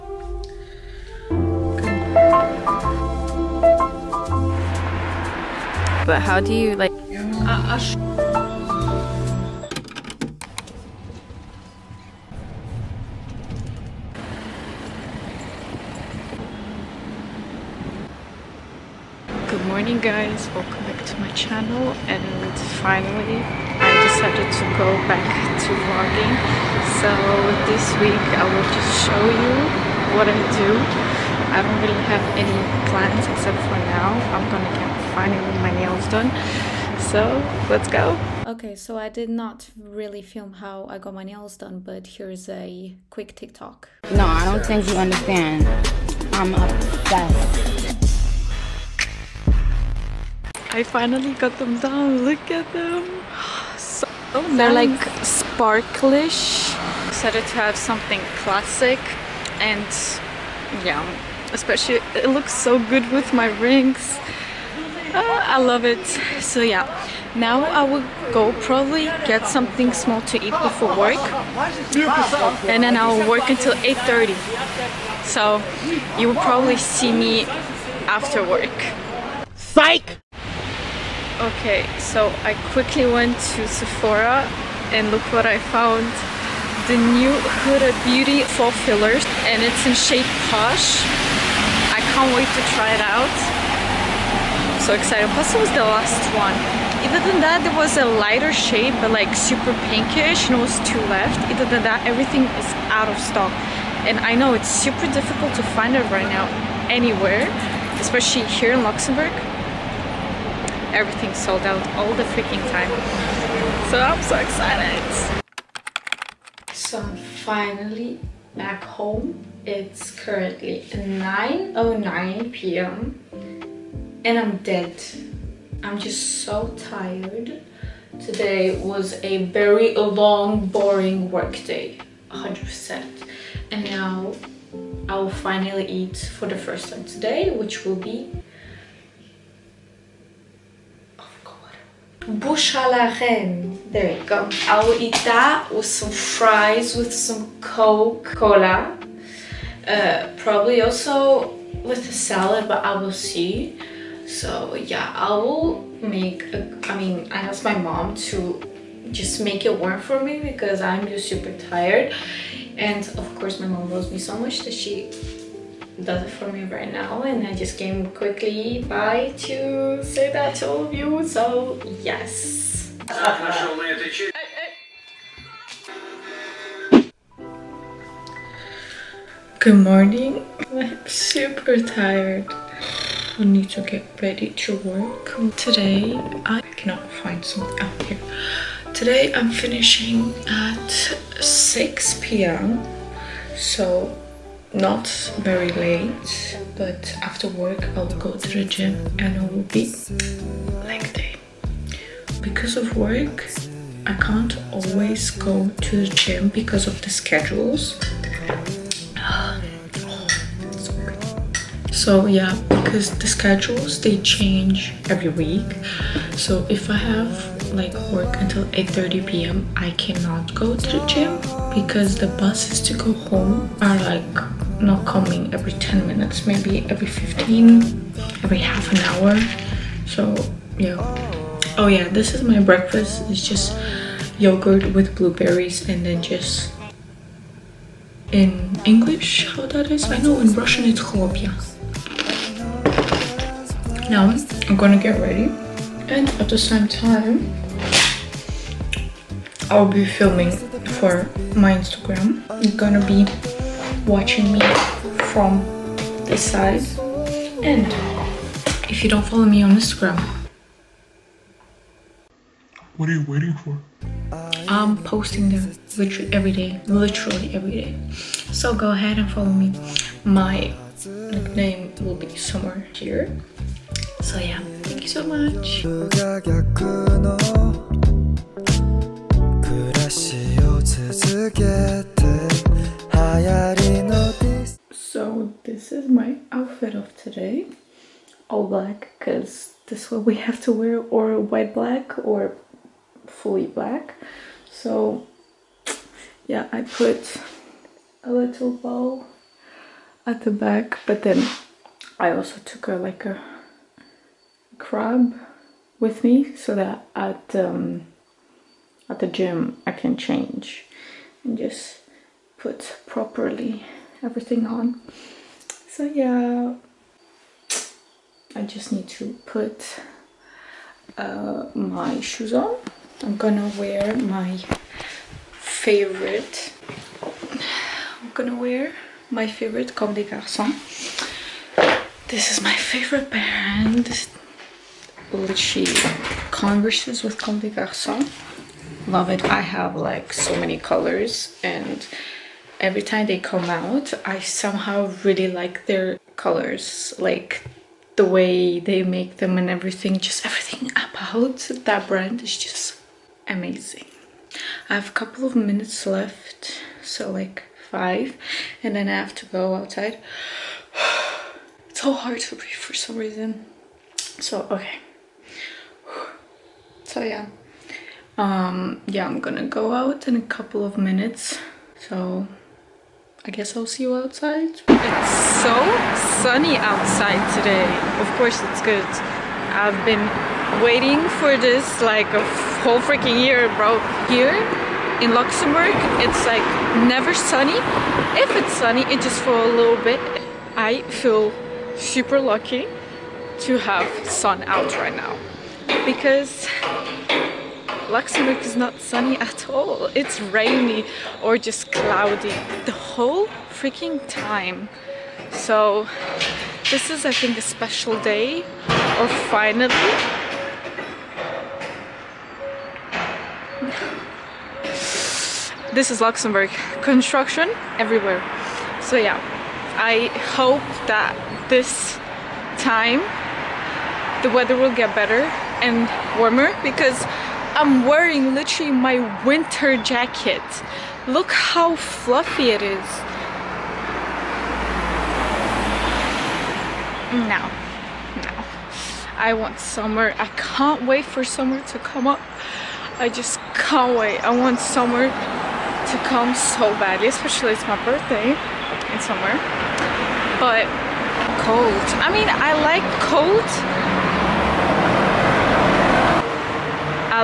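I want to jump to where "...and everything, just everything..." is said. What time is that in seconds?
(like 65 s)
349 s.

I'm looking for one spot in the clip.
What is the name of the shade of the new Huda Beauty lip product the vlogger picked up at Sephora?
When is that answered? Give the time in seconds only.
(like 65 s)
90 s.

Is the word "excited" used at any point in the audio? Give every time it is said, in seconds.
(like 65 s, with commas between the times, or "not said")
57 s, 94 s, 114 s.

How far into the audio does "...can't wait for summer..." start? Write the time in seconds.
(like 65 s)
440 s.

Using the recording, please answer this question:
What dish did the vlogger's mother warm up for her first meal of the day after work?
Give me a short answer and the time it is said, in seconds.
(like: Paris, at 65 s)
Bouche à la reine, at 142 s.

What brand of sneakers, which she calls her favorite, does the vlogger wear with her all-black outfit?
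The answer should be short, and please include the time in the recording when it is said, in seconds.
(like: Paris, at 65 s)
Comme des Garçons, at 329 s.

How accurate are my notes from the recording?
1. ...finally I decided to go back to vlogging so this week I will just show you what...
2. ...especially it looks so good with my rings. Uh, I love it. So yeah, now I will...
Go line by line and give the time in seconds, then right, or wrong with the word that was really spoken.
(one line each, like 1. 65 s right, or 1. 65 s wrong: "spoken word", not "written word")
1. 22 s right
2. 61 s right.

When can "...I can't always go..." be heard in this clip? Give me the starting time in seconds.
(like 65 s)
204 s.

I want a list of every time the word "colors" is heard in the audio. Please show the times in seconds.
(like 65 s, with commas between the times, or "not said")
340 s, 346 s.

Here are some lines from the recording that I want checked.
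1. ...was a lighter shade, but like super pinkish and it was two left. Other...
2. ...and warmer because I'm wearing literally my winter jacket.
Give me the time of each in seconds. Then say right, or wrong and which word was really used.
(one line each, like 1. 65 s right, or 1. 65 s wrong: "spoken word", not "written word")
1. 97 s right
2. 425 s right.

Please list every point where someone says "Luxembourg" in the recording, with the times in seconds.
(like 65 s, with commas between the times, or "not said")
108 s, 385 s, 398 s, 416 s.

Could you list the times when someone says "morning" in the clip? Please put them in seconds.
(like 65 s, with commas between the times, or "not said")
19 s, 179 s.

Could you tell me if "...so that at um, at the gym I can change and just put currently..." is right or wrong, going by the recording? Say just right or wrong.
wrong.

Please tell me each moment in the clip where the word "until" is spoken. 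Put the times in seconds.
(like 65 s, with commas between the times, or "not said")
73 s, 218 s.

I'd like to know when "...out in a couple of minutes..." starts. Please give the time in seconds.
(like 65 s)
369 s.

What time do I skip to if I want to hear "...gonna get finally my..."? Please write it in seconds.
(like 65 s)
34 s.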